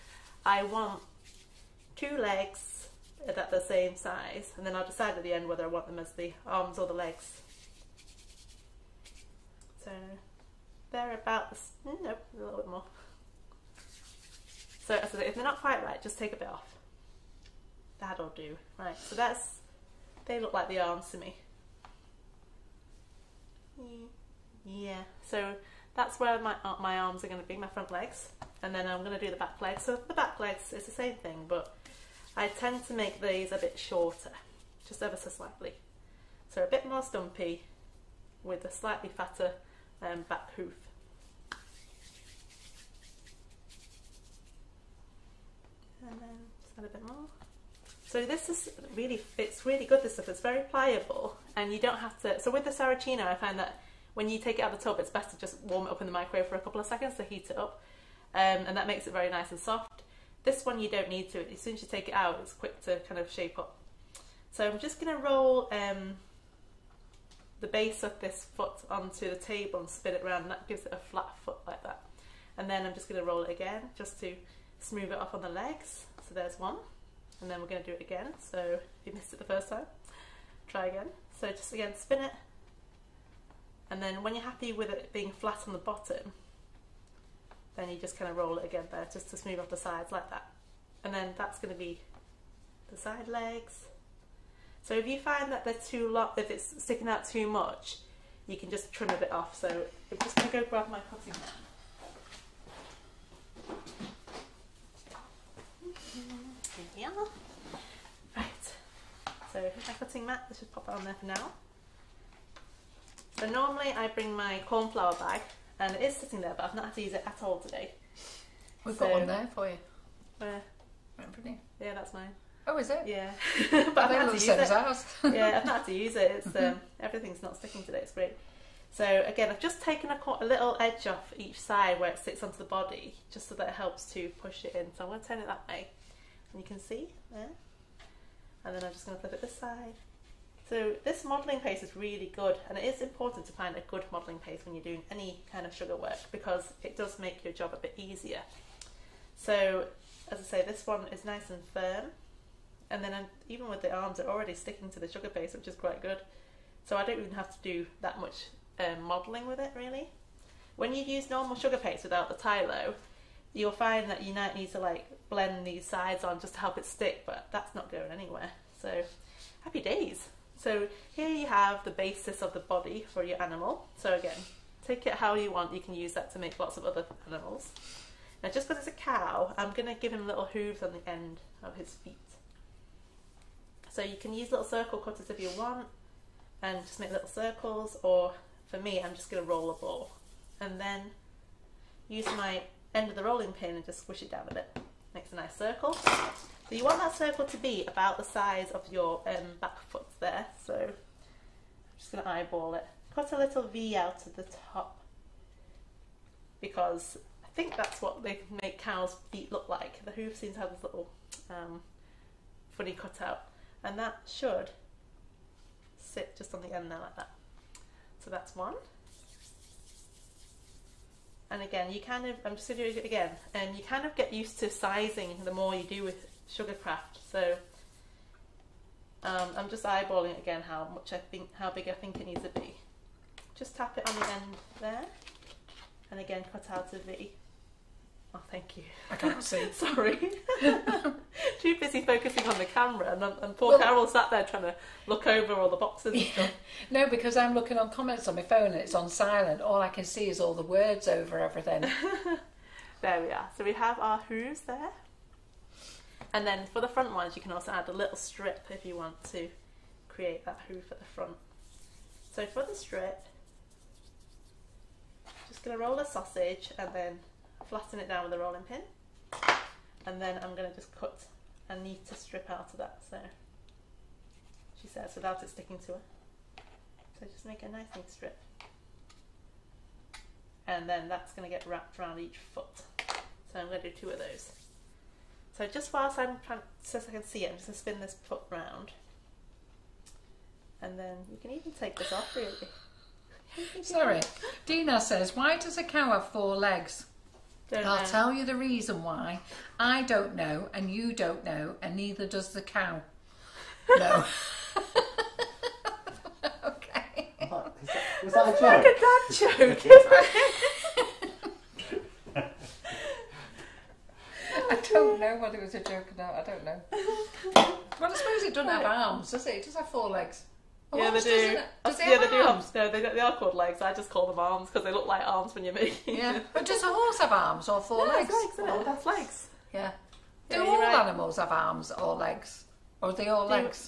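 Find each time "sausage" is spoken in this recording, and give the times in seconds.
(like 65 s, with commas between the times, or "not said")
266 s.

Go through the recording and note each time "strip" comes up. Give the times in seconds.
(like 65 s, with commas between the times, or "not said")
258 s, 262 s, 272 s, 278 s.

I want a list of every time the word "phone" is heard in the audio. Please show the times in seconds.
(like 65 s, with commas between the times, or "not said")
248 s.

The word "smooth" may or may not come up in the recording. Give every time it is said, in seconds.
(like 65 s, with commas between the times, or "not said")
74 s, 89 s.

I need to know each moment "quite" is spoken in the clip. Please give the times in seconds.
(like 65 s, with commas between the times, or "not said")
15 s, 155 s.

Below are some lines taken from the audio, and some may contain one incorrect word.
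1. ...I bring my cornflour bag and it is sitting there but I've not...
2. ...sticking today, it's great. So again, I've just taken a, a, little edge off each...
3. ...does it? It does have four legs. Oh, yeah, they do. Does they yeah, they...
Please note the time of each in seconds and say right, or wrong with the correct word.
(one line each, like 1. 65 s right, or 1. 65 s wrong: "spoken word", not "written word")
1. 113 s right
2. 127 s right
3. 319 s right.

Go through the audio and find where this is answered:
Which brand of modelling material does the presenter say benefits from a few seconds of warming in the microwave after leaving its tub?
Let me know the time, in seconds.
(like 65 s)
52 s.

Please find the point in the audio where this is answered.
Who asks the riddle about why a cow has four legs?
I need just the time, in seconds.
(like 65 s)
294 s.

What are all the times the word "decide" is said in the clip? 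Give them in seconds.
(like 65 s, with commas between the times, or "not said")
4 s.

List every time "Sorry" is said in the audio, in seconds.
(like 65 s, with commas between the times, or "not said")
239 s, 293 s.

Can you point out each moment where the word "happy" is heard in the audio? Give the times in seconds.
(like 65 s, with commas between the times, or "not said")
84 s, 169 s.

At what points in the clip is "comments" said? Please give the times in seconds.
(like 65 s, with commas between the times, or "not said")
247 s.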